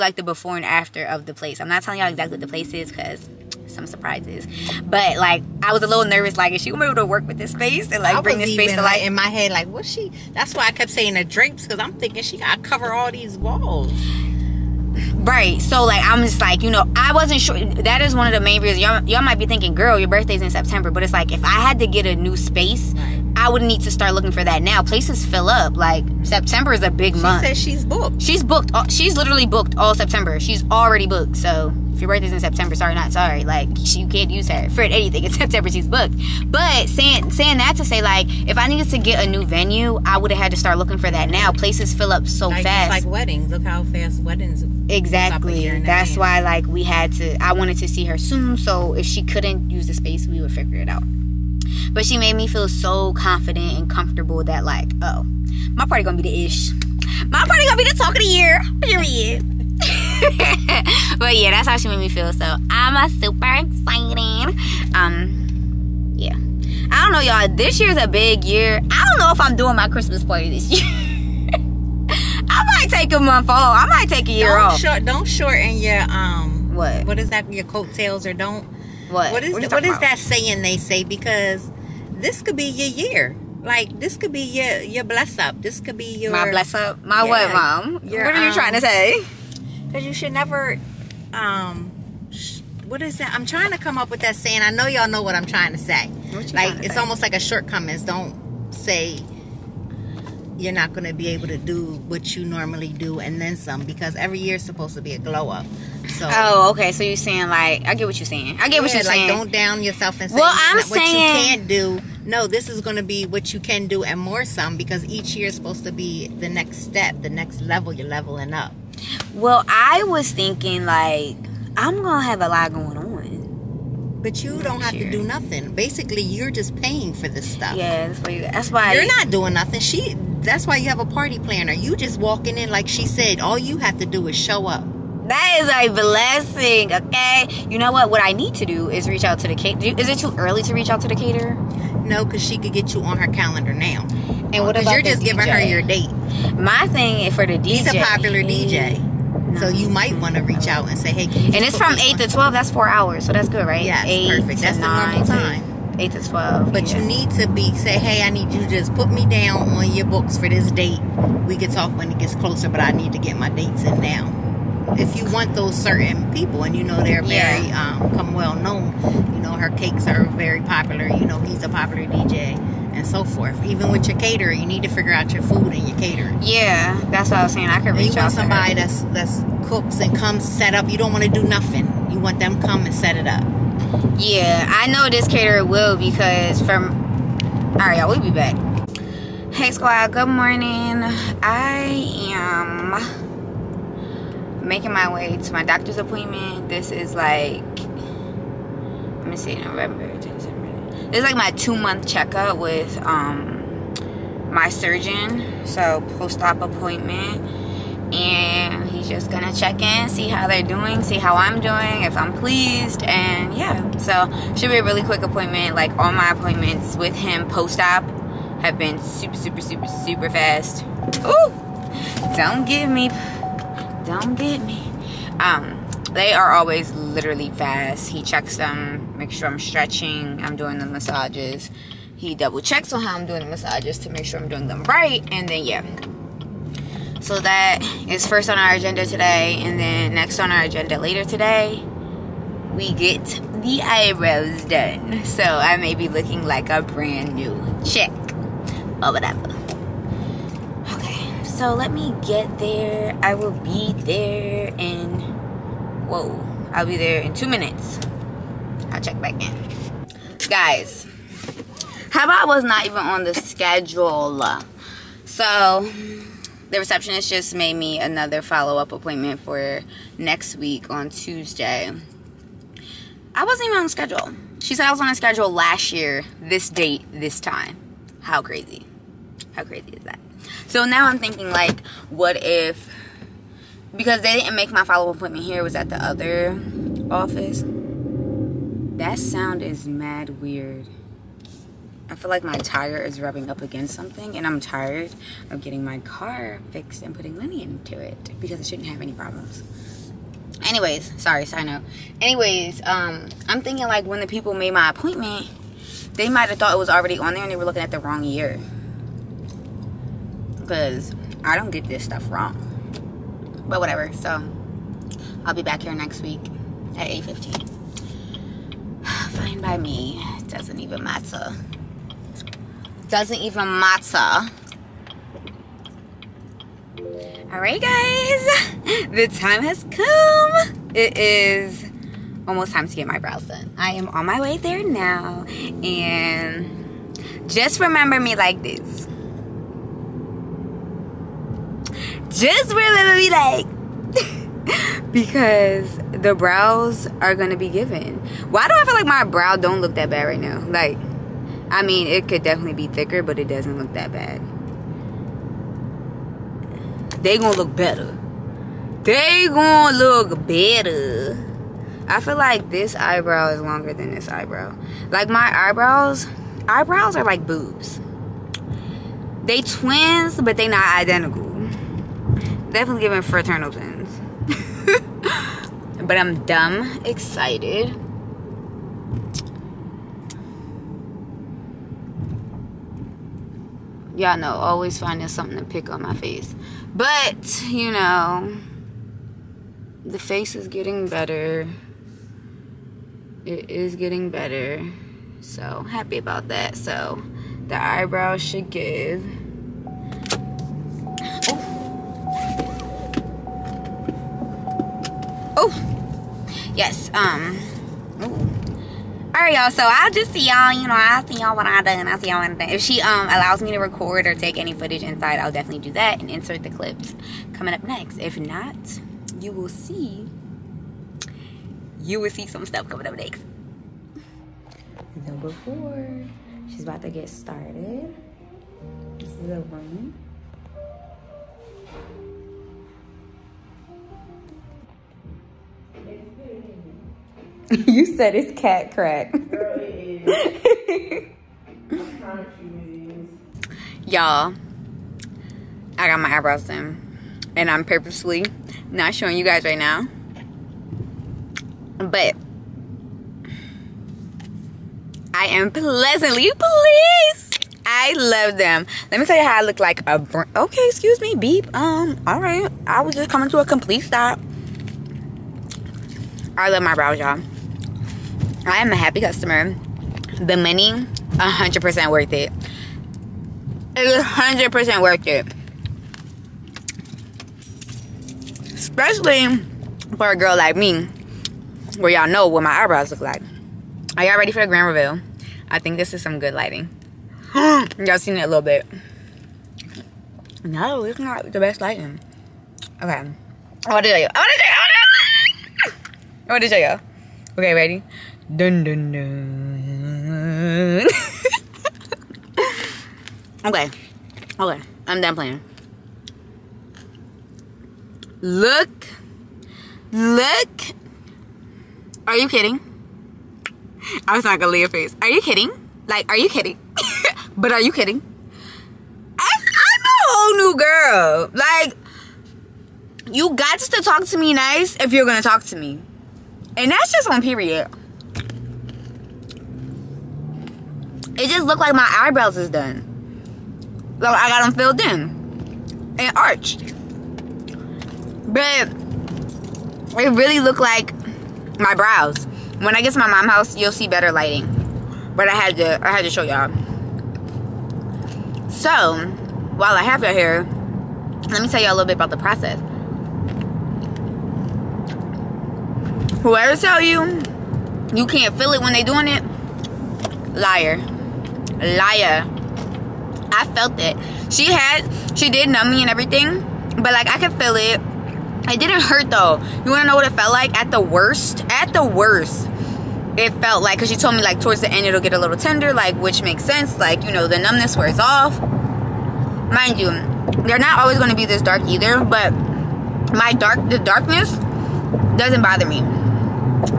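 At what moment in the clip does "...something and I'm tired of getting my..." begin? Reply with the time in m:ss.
4:53.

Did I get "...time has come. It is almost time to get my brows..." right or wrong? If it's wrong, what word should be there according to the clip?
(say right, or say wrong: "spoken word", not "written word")
right.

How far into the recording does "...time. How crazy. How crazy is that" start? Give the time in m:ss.
4:37.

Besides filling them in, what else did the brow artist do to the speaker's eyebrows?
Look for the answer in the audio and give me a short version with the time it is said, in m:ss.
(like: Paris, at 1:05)
Arched, at 8:56.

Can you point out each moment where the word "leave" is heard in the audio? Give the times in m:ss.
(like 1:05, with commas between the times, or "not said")
8:34.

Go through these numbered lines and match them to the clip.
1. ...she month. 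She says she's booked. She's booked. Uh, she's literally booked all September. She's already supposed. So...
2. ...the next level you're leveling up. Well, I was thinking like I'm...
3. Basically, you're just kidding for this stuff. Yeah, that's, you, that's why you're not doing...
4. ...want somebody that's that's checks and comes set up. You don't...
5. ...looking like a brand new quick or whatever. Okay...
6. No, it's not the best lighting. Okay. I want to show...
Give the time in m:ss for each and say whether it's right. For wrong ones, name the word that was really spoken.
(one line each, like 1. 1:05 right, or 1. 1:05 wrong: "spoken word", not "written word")
1. 0:27 wrong: "booked", not "supposed"
2. 1:57 right
3. 2:05 wrong: "paying", not "kidding"
4. 2:58 wrong: "cooks", not "checks"
5. 4:06 wrong: "chick", not "quick"
6. 8:10 right.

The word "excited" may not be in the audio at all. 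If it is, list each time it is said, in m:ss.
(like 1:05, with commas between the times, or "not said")
1:03, 6:17.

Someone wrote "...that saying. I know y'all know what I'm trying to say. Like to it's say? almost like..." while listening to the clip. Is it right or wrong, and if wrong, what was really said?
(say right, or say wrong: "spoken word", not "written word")
right.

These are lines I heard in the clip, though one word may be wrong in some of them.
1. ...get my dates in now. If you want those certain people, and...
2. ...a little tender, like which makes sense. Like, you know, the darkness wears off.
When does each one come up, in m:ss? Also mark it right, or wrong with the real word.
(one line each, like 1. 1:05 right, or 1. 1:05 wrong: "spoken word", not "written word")
1. 2:43 right
2. 9:35 wrong: "numbness", not "darkness".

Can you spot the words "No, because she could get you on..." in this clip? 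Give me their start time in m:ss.
2:22.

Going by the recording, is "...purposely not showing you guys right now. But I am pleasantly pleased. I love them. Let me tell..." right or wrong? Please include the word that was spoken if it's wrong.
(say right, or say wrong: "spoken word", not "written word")
right.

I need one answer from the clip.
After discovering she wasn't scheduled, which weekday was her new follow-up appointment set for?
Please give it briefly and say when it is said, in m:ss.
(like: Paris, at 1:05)
Tuesday, at 4:30.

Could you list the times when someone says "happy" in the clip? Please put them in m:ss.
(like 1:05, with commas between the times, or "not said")
6:35, 7:48.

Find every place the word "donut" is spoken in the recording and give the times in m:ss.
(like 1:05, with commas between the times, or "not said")
not said.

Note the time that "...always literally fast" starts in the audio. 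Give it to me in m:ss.
3:46.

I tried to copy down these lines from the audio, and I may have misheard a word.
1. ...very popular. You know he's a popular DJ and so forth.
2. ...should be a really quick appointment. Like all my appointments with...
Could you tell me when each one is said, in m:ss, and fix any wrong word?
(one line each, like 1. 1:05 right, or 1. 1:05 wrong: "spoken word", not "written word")
1. 2:50 right
2. 3:34 right.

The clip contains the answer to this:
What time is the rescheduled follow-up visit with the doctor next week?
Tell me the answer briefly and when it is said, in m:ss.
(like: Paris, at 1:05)
8:15, at 5:17.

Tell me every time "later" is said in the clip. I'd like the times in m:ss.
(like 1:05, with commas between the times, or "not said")
4:00.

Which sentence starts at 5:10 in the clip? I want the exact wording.
Because I don't get this stuff wrong.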